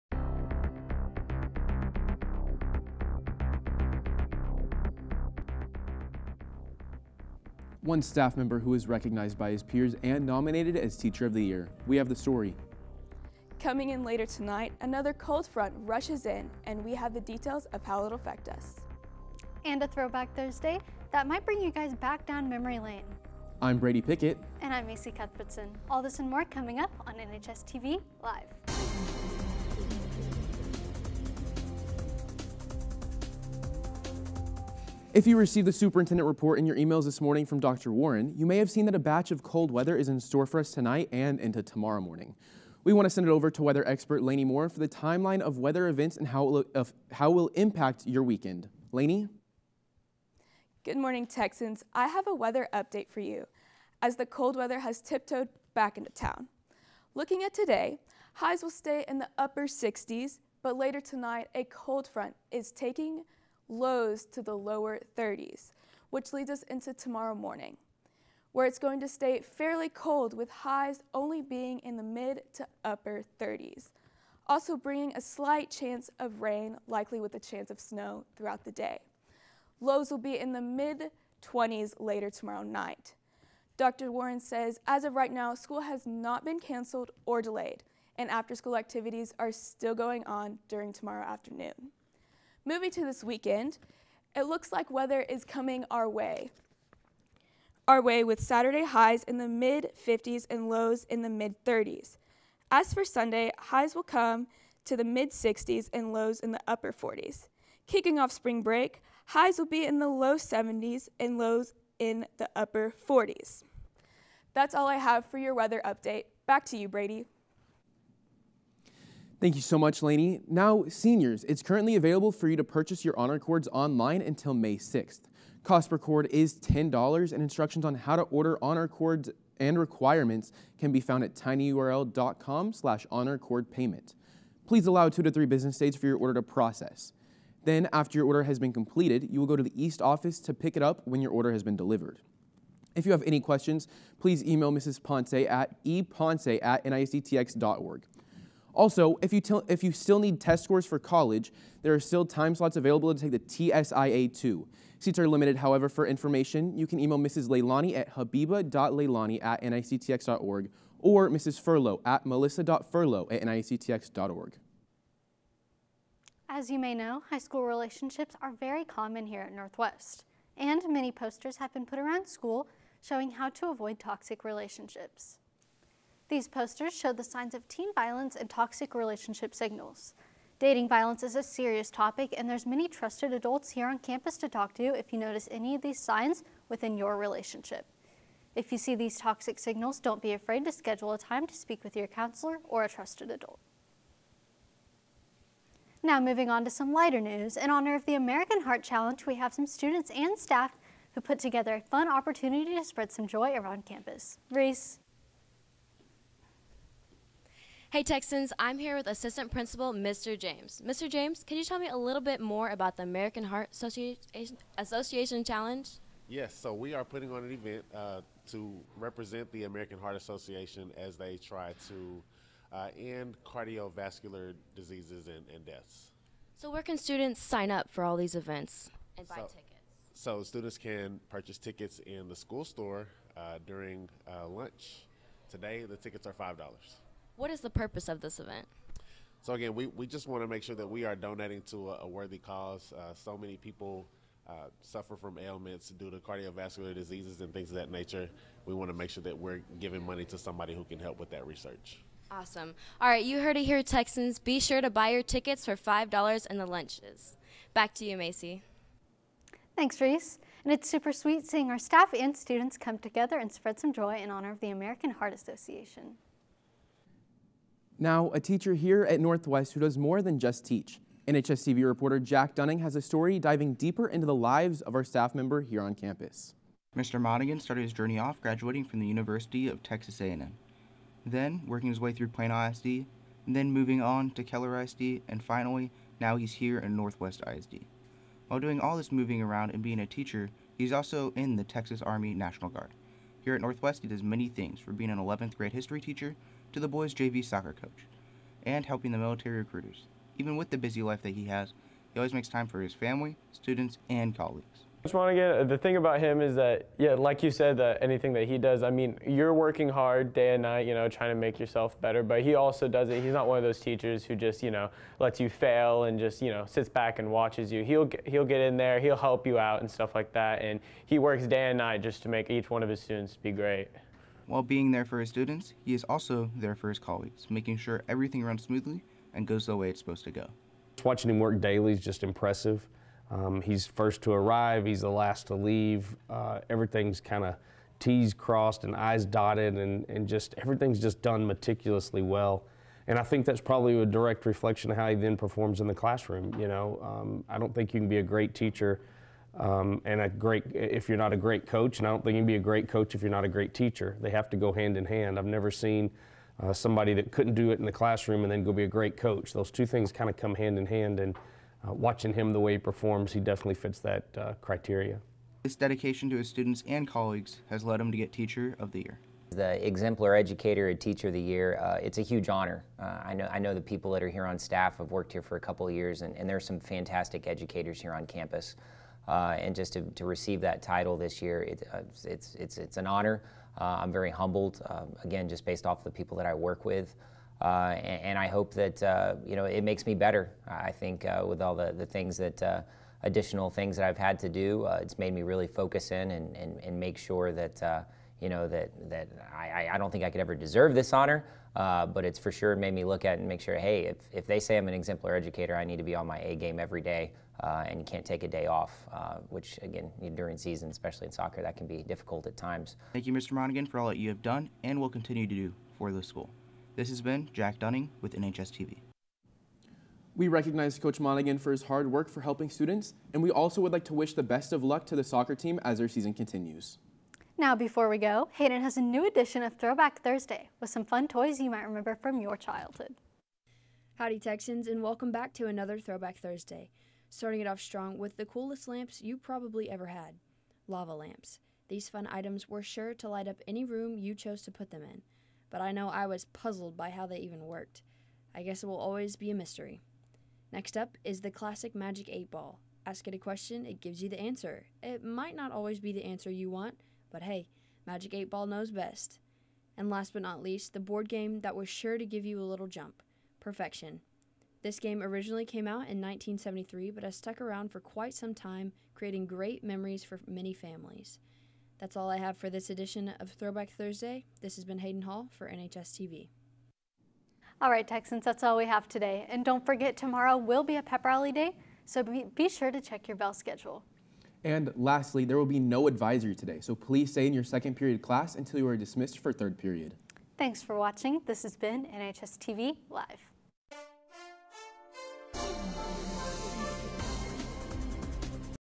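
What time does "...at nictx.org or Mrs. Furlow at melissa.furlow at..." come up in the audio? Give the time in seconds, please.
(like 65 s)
159 s.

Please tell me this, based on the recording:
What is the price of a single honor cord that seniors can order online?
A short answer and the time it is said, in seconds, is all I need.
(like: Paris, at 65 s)
$10, at 126 s.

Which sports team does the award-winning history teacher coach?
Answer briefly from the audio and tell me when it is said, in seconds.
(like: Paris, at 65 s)
boys' JV soccer, at 296 s.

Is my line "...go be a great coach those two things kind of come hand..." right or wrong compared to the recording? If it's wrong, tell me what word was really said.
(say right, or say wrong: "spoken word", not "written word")
right.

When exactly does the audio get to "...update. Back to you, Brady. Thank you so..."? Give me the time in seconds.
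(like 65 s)
115 s.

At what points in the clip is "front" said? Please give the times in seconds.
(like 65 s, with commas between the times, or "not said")
15 s, 62 s.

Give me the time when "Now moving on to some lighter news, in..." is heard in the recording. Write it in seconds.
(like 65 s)
196 s.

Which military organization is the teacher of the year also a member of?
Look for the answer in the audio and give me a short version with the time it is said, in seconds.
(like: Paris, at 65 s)
Texas Army National Guard, at 291 s.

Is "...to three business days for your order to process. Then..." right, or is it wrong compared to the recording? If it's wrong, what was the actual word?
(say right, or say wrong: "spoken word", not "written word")
right.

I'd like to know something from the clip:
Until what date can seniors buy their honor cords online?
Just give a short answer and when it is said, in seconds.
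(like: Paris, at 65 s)
May 6th, at 124 s.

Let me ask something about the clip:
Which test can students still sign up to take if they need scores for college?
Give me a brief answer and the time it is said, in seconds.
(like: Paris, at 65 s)
TSIA 2, at 153 s.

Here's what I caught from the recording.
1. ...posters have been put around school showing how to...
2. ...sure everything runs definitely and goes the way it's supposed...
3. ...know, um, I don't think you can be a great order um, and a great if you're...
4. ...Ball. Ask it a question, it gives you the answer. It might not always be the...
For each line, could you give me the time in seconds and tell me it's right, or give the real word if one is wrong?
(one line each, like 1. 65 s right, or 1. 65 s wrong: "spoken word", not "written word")
1. 171 s right
2. 327 s wrong: "smoothly", not "definitely"
3. 346 s wrong: "teacher", not "order"
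4. 452 s right.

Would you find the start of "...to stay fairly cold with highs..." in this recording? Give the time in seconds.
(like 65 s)
68 s.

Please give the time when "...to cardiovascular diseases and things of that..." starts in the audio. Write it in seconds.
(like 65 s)
246 s.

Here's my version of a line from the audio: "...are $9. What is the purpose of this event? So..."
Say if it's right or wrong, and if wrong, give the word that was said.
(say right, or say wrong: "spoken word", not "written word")
wrong: "5", not "9".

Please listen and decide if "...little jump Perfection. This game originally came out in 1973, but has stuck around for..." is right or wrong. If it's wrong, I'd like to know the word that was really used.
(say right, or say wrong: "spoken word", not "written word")
right.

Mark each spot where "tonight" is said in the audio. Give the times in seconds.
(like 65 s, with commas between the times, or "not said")
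14 s, 40 s, 61 s.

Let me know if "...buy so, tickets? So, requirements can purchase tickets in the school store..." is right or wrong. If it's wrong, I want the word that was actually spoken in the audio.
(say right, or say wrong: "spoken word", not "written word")
wrong: "students", not "requirements".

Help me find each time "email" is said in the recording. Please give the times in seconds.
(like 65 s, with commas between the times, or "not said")
36 s, 144 s, 156 s.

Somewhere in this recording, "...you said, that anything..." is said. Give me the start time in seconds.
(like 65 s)
307 s.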